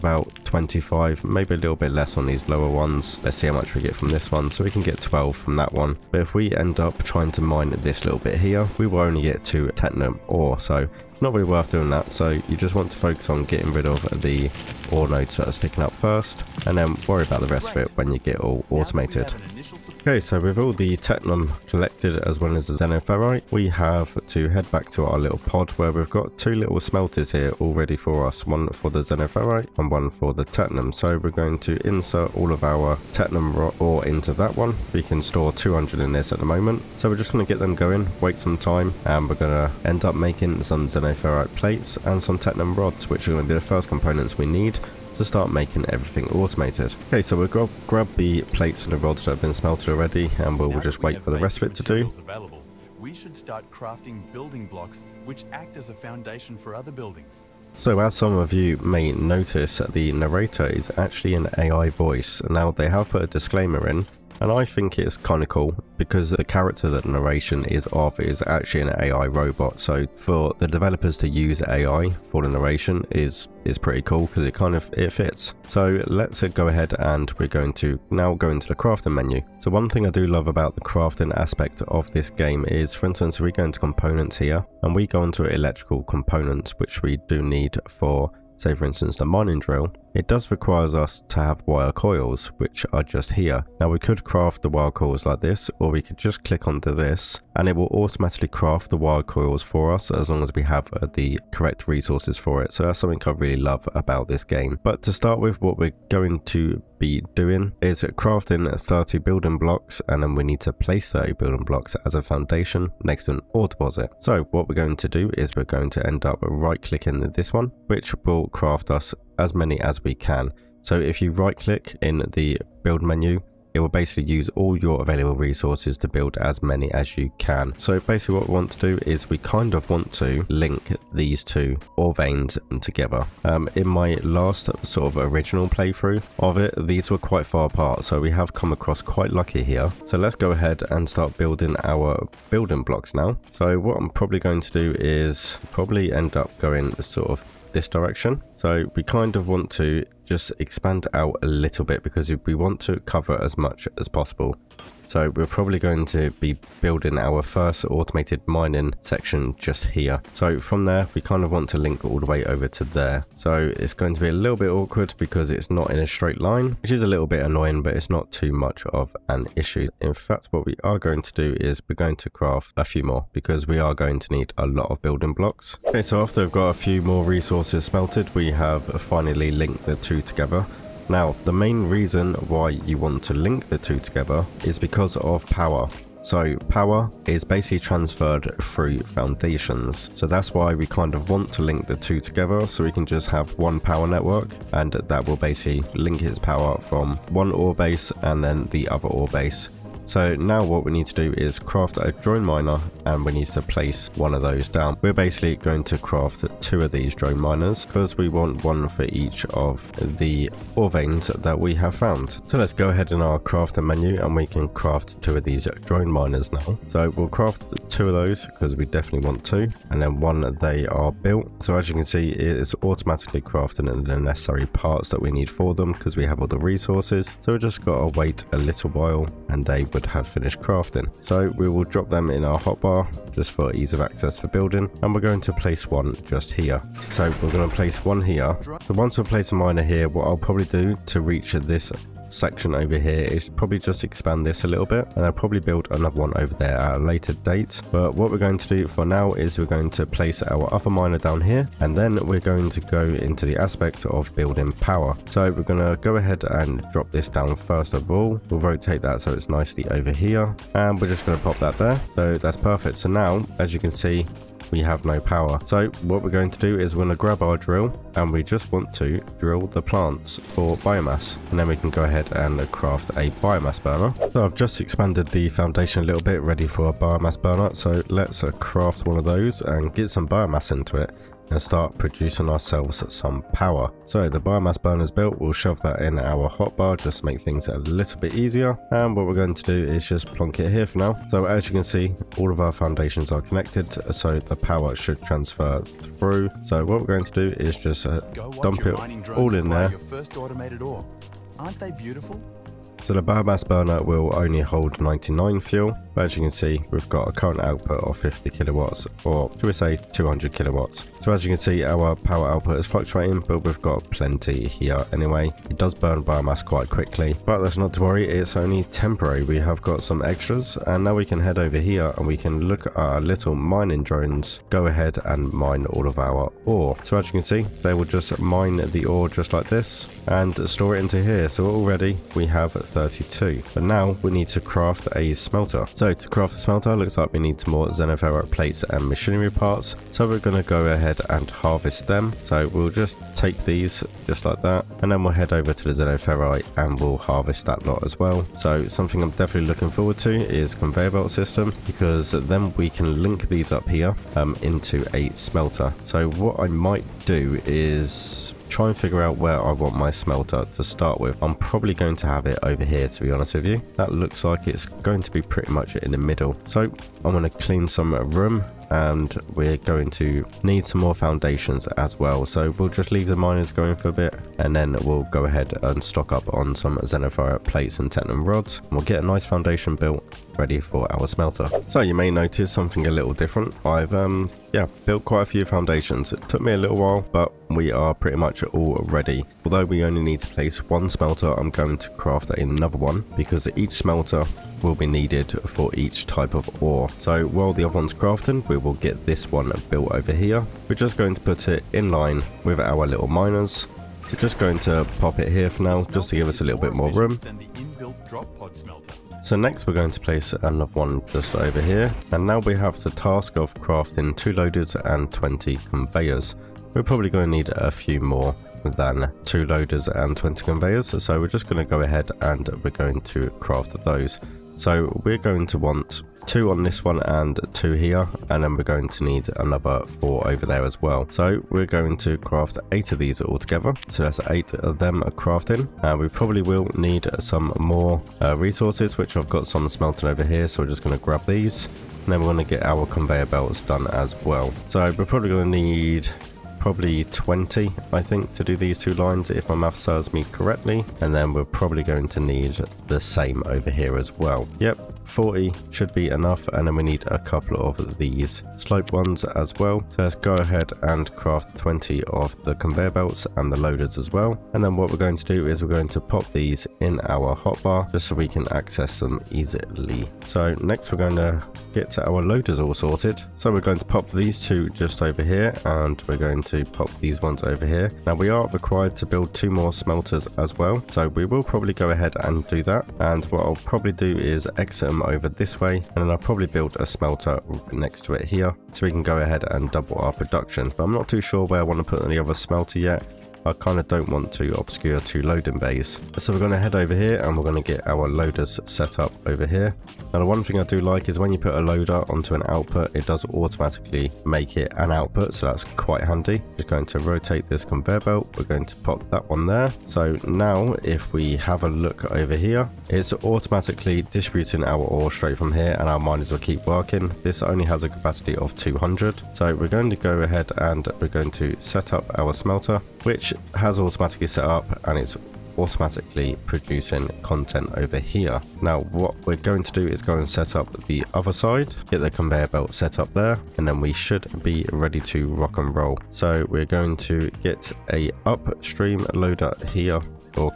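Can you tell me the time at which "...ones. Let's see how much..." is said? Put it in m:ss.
0:02.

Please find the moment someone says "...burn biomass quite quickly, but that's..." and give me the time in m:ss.
5:15.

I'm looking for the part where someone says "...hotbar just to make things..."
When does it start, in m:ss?
4:46.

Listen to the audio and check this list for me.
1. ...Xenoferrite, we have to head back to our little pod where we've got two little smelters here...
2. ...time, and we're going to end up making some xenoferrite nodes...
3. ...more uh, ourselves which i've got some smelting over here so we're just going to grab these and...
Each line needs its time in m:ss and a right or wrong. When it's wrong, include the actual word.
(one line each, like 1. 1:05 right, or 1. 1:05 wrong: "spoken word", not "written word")
1. 0:22 right
2. 0:38 wrong: "plates", not "nodes"
3. 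7:17 wrong: "resources", not "ourselves".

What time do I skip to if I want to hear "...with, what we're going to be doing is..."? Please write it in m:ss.
1:45.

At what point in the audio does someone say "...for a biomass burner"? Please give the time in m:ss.
4:36.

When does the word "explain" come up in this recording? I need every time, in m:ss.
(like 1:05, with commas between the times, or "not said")
not said.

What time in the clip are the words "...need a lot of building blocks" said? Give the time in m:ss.
2:54.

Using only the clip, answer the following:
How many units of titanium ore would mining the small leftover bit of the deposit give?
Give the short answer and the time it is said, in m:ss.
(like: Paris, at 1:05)
2, at 0:09.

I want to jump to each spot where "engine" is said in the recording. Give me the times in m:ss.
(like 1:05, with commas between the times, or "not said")
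not said.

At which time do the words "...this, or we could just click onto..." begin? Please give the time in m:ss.
1:35.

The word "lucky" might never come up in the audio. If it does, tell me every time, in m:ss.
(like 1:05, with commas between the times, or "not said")
2:19.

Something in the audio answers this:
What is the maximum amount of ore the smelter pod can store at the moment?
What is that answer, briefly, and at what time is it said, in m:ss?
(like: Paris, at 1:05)
200, at 0:34.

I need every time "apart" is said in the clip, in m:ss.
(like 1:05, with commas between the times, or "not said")
2:17.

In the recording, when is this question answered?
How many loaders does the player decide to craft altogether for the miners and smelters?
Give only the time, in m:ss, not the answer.
7:12.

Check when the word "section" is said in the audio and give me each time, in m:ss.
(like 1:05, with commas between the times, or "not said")
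2:39, 4:02.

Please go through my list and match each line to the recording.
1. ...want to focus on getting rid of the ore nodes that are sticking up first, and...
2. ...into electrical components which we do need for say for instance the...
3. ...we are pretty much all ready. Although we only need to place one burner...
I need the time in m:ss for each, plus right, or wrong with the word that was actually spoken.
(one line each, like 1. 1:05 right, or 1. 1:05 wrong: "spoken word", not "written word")
1. 0:12 right
2. 1:25 right
3. 6:27 wrong: "smelter", not "burner".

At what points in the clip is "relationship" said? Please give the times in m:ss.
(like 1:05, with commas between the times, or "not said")
not said.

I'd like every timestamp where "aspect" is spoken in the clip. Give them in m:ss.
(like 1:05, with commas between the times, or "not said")
1:21, 4:13.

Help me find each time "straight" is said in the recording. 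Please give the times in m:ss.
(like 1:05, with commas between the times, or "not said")
2:46, 8:35.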